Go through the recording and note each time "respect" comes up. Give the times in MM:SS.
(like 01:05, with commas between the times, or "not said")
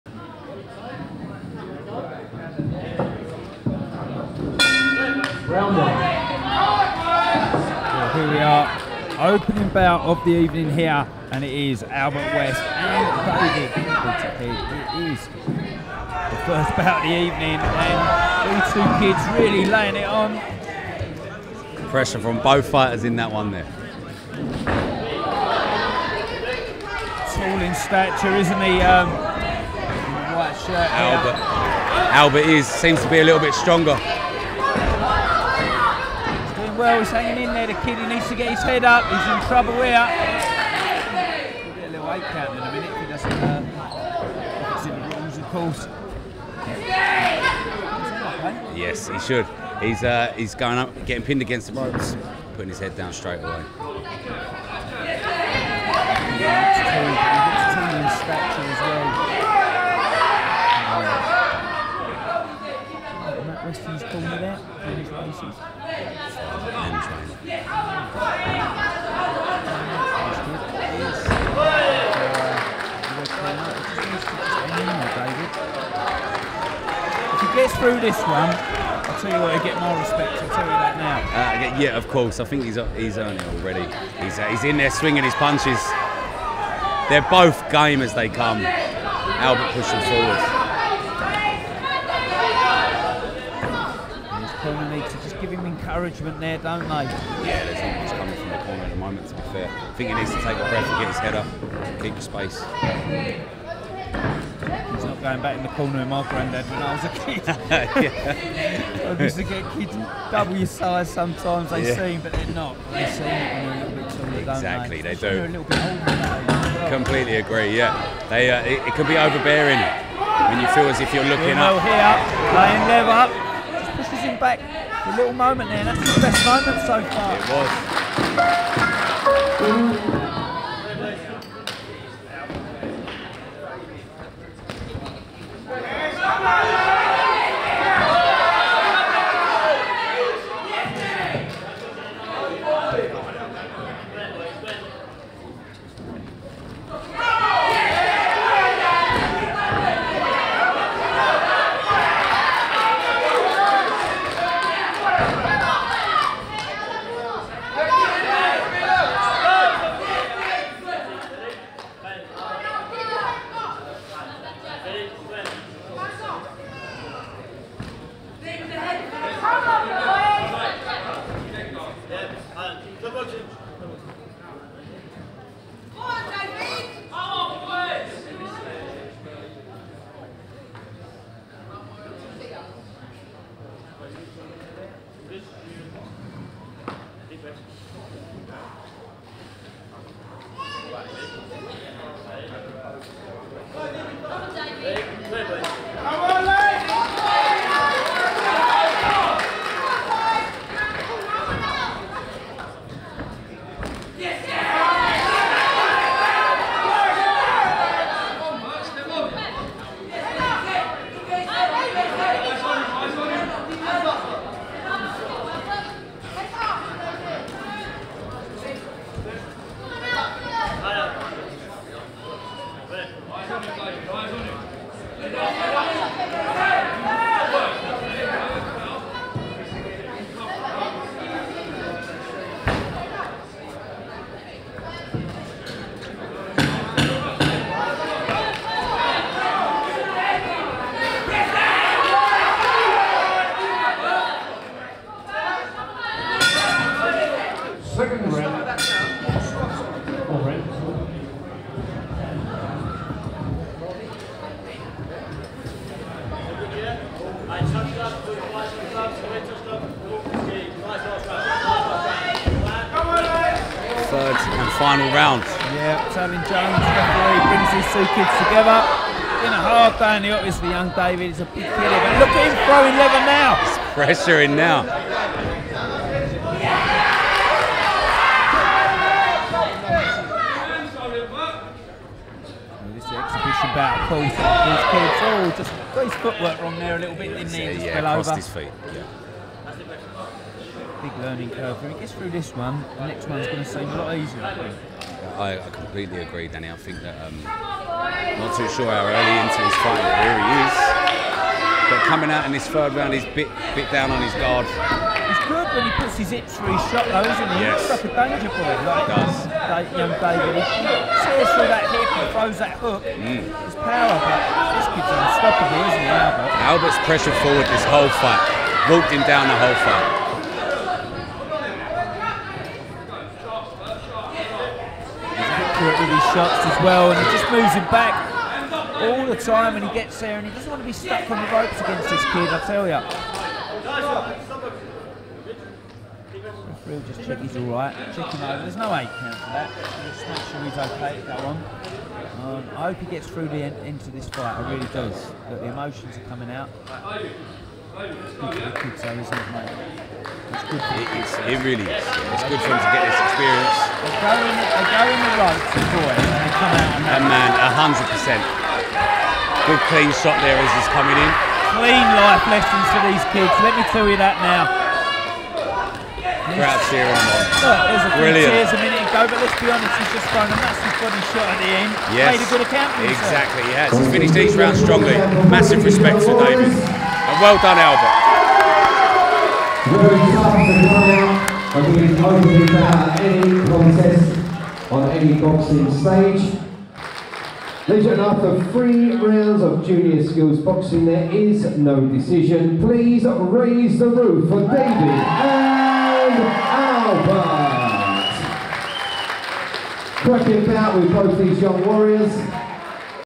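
01:19, 06:15.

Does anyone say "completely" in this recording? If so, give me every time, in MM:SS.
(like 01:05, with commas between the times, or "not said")
01:56, 04:55.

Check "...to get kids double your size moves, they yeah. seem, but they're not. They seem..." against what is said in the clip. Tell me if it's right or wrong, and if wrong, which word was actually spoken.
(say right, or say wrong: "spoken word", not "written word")
wrong: "sometimes", not "moves".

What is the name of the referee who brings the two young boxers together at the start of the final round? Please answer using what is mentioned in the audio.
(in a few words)
Tony Jones.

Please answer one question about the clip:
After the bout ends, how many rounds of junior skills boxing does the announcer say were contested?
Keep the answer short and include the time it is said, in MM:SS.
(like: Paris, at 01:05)
3, at 06:28.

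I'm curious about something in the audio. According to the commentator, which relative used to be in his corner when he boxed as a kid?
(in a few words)
Granddad.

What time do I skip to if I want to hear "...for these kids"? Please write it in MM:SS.
06:02.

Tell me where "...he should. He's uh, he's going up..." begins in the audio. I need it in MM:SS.
00:49.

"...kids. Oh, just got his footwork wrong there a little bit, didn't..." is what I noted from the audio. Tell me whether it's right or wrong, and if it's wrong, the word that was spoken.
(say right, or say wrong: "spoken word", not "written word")
right.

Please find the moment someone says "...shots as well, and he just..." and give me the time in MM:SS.
05:26.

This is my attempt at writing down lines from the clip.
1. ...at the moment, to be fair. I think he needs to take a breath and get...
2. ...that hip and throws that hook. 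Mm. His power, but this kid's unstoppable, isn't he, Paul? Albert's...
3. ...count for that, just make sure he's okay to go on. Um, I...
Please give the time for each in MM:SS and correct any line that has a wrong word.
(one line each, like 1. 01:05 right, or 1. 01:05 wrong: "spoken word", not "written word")
1. 01:38 right
2. 05:11 wrong: "Albert", not "Paul"
3. 05:39 right.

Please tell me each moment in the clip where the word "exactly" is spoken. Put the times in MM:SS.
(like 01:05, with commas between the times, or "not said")
01:54, 06:13.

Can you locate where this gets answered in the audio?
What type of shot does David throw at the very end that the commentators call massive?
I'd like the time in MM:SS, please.
06:10.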